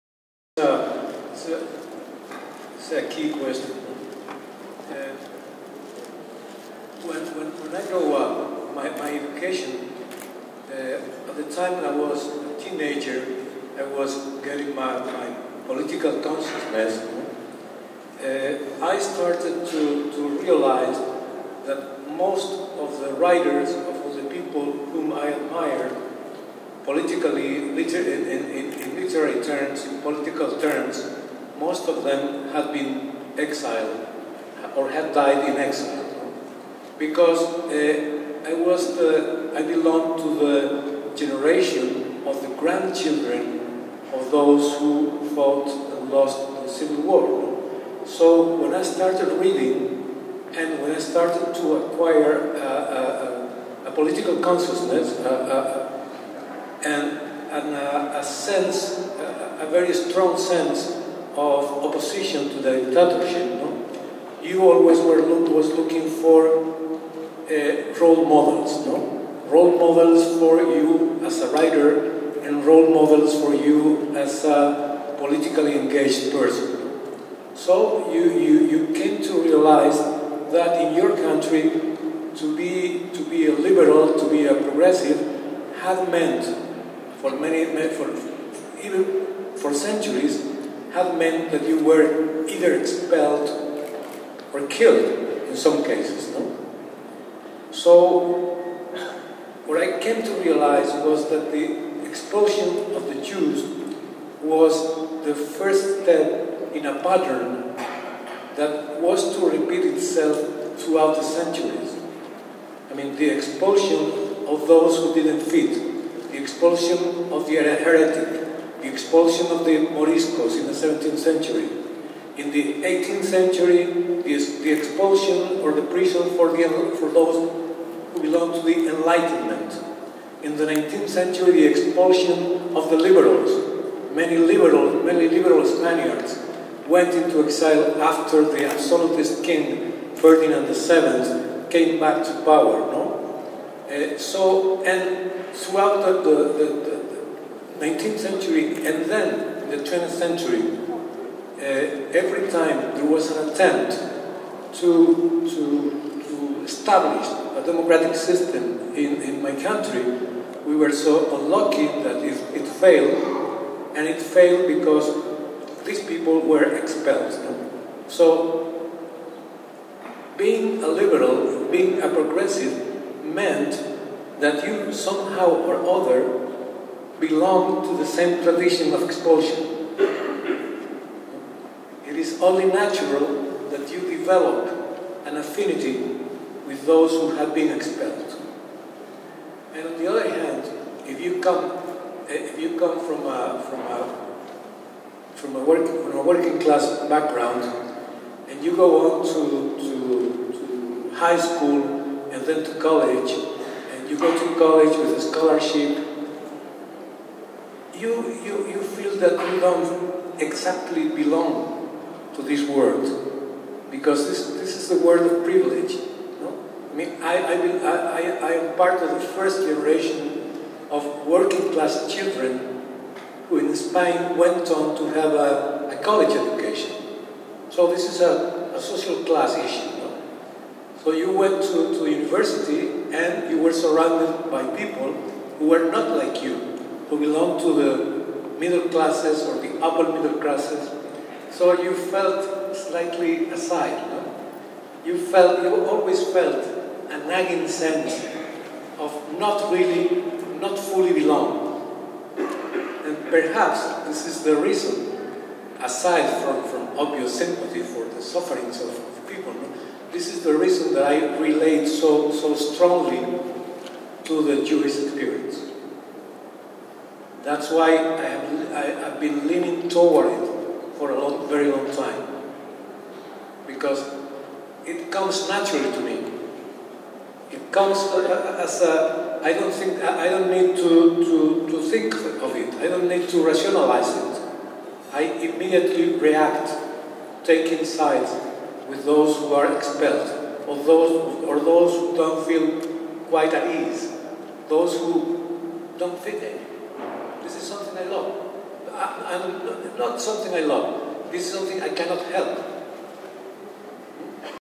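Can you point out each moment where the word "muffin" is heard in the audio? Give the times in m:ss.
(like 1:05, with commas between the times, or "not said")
not said.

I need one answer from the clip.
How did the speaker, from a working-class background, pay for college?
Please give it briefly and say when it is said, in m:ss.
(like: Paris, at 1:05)
a scholarship, at 3:25.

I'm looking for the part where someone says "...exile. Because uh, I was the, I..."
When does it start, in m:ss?
0:35.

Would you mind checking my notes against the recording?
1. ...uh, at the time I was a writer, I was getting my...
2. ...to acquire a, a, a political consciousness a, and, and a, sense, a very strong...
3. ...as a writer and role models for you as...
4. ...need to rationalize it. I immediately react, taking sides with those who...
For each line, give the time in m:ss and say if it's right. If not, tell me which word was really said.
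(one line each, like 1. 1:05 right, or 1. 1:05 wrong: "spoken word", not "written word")
1. 0:10 wrong: "teenager", not "writer"
2. 0:51 right
3. 1:11 right
4. 4:43 right.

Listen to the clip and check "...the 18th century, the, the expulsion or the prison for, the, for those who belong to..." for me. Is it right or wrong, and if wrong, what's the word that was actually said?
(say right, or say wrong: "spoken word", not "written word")
right.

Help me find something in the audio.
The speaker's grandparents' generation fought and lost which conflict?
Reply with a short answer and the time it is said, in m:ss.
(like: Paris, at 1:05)
the Civil War, at 0:46.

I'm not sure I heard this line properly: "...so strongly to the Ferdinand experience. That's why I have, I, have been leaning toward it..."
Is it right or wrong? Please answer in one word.
wrong.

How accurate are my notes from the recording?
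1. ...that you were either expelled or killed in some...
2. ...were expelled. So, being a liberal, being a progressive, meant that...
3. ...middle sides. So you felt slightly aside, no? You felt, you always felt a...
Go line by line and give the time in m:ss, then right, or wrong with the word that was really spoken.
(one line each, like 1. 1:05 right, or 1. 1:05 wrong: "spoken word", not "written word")
1. 1:31 right
2. 2:46 right
3. 4:00 wrong: "classes", not "sides".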